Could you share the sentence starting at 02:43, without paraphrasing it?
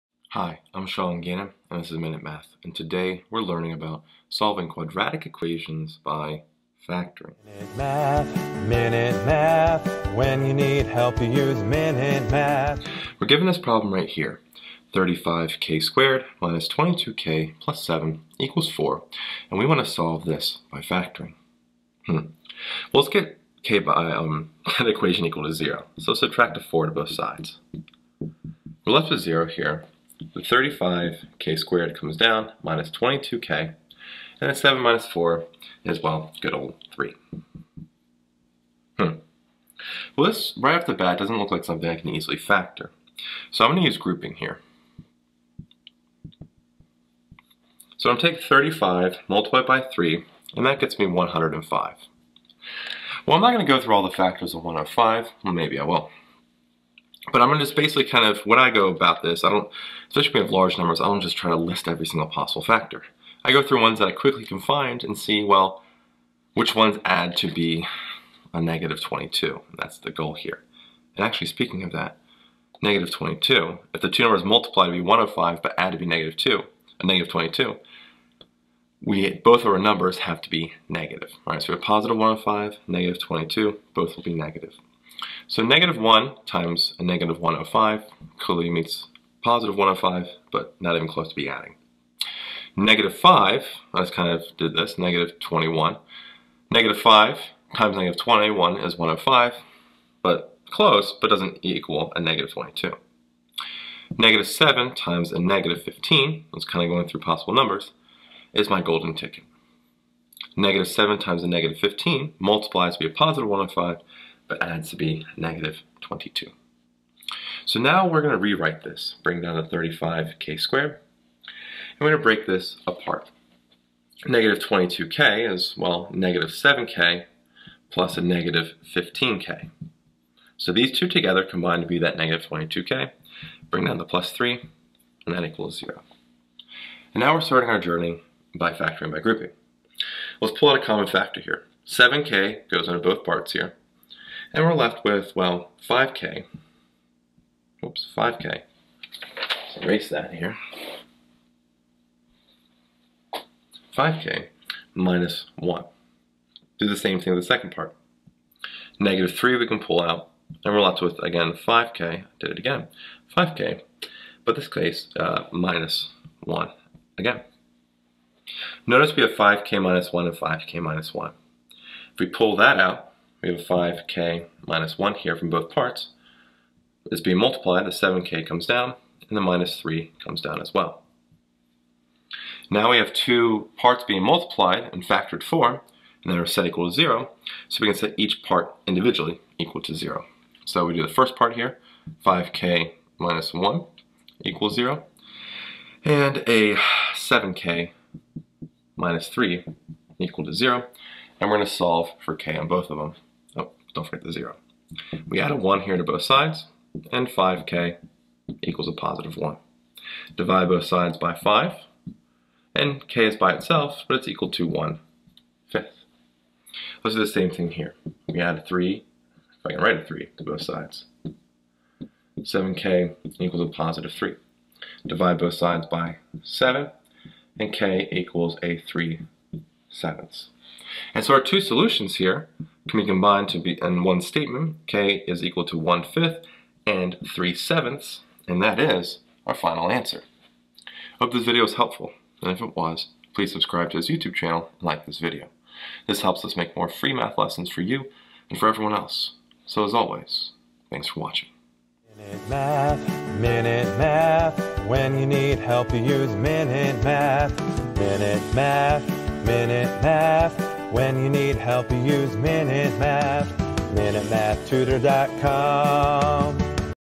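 5k, but this case, uh, minus 1 again.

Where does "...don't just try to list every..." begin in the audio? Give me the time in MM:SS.
01:01.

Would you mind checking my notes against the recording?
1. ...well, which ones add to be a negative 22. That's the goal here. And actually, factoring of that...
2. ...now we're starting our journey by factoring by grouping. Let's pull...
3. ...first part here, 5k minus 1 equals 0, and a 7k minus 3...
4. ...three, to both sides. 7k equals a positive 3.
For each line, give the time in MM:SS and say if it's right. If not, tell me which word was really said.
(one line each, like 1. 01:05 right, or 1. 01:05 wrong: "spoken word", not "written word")
1. 01:05 wrong: "speaking", not "factoring"
2. 02:17 right
3. 03:11 right
4. 03:40 right.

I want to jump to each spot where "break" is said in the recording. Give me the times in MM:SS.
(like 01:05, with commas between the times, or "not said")
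02:02.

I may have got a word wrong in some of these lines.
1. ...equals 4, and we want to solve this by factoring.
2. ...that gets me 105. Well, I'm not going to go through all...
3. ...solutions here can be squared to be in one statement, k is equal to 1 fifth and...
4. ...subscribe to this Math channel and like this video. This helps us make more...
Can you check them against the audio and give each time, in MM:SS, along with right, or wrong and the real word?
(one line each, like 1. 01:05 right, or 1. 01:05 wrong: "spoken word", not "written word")
1. 00:18 right
2. 00:50 right
3. 03:51 wrong: "combined", not "squared"
4. 04:03 wrong: "YouTube", not "Math".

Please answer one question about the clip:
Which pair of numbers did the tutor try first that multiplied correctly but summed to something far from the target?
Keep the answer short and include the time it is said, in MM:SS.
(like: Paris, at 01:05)
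-1 and -105, at 01:25.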